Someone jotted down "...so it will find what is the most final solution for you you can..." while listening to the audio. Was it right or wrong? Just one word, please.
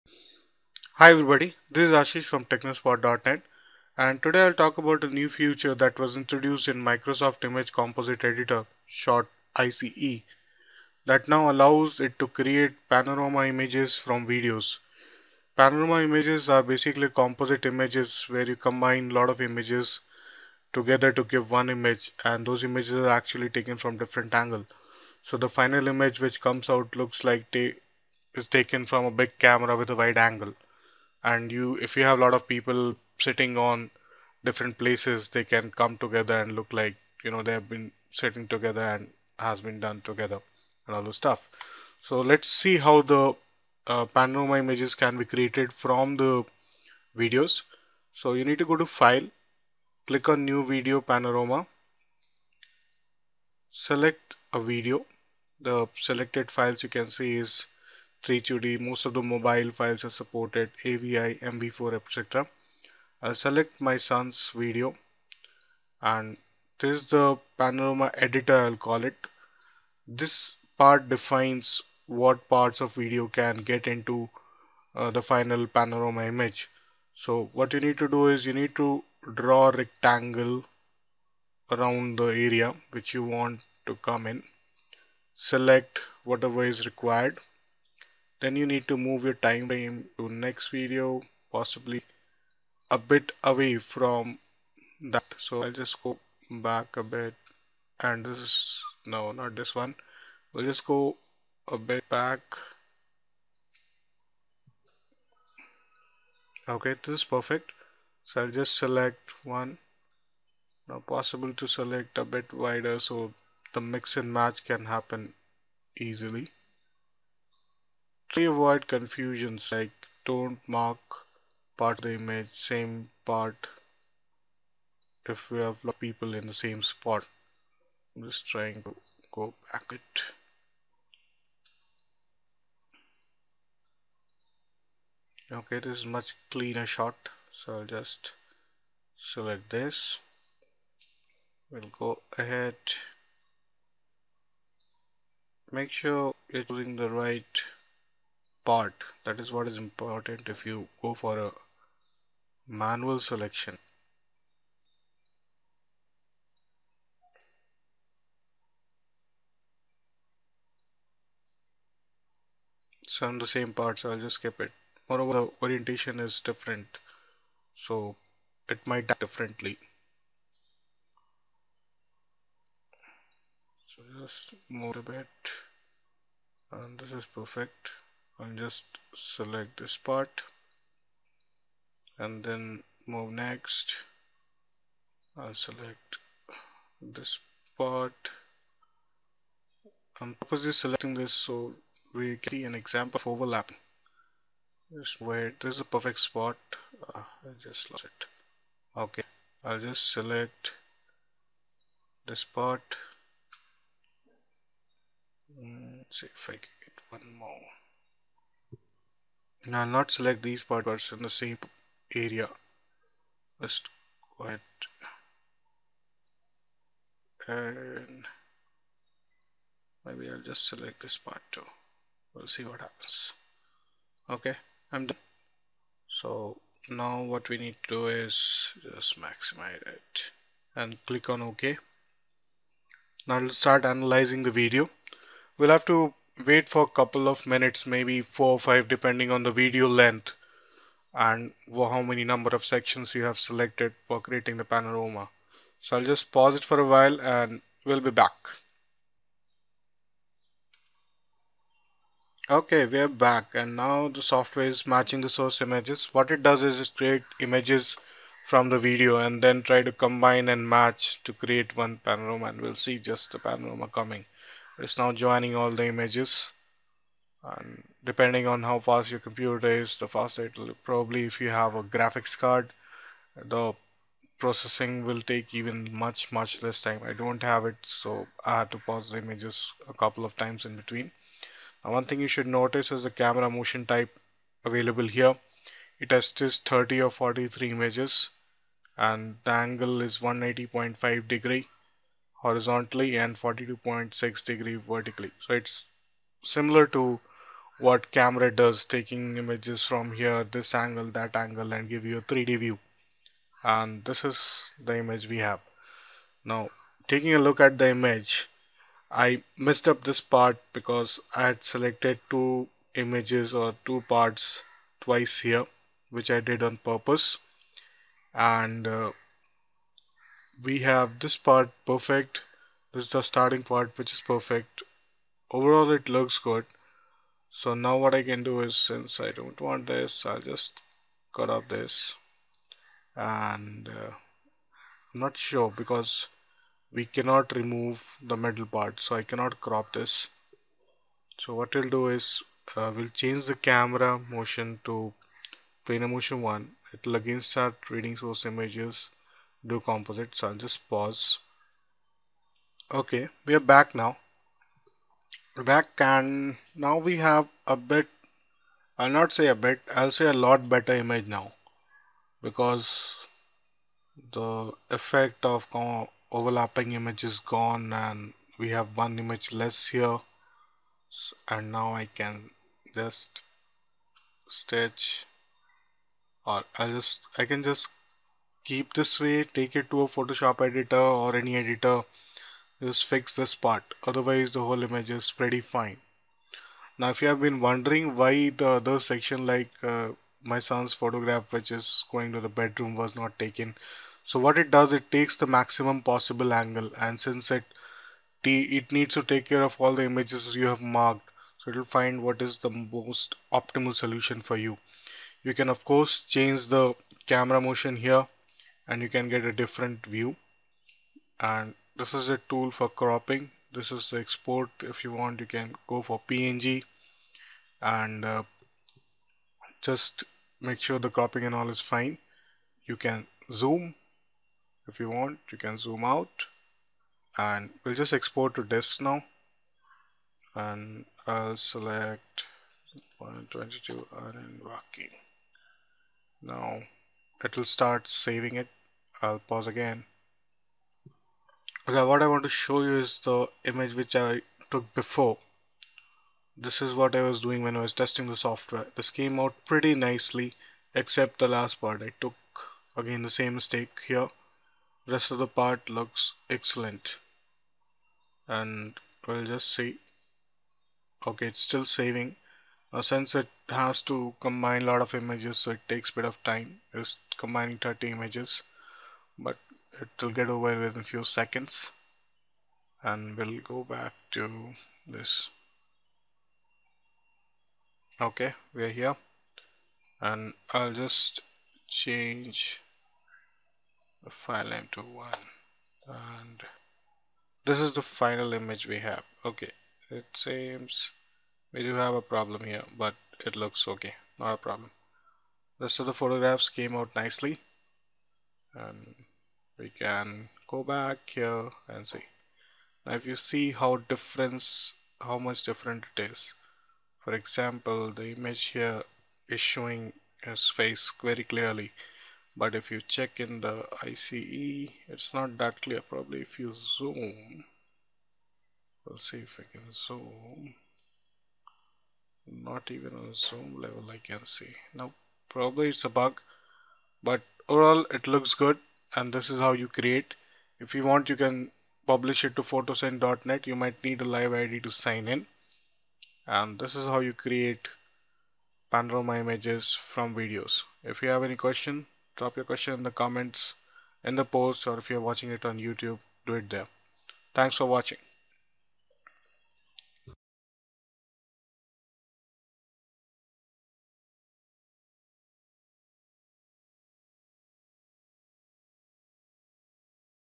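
wrong.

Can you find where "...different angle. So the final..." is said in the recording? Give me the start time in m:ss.
0:23.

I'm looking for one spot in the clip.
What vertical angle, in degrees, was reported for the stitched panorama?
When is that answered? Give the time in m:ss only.
4:53.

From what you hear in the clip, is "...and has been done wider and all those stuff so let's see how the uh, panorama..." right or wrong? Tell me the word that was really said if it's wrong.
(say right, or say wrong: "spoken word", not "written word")
wrong: "together", not "wider".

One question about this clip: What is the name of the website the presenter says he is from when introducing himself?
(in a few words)
Technospot.net.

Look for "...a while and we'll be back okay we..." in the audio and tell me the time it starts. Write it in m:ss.
4:06.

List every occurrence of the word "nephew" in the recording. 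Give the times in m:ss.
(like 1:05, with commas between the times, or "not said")
not said.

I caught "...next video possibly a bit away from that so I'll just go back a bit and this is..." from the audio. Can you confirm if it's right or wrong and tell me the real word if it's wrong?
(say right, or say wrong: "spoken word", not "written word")
right.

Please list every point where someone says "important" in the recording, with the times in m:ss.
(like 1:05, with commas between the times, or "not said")
2:29.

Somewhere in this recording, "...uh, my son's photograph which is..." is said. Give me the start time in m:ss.
6:29.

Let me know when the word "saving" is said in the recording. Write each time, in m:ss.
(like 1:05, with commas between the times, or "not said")
7:18, 7:41.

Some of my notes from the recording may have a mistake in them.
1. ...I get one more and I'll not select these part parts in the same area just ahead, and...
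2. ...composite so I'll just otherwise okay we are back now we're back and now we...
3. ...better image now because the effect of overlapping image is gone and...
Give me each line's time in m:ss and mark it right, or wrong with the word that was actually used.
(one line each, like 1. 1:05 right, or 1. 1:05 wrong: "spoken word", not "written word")
1. 3:26 right
2. 5:49 wrong: "pause", not "otherwise"
3. 6:00 right.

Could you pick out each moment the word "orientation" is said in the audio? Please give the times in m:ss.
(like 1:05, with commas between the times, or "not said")
2:45.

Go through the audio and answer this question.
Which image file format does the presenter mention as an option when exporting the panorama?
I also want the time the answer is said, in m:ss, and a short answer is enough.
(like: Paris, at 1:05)
PNG, at 6:56.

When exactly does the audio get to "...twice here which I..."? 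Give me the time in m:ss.
5:15.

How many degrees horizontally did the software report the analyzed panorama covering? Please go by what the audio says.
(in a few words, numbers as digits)
180.5 degrees.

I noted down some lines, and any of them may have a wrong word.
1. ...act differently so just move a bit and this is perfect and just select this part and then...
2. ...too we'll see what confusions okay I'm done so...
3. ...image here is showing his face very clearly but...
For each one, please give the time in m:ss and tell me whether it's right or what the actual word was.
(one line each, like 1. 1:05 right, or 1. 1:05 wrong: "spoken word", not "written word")
1. 2:49 right
2. 3:41 wrong: "happens", not "confusions"
3. 8:28 right.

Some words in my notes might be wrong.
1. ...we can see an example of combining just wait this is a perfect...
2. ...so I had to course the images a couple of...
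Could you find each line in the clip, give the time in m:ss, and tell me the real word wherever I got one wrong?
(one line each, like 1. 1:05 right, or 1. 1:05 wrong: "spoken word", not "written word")
1. 3:12 wrong: "overlapping", not "combining"
2. 4:37 wrong: "pause", not "course".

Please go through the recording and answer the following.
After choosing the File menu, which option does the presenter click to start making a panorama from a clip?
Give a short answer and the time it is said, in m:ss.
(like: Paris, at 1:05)
New video panorama, at 0:50.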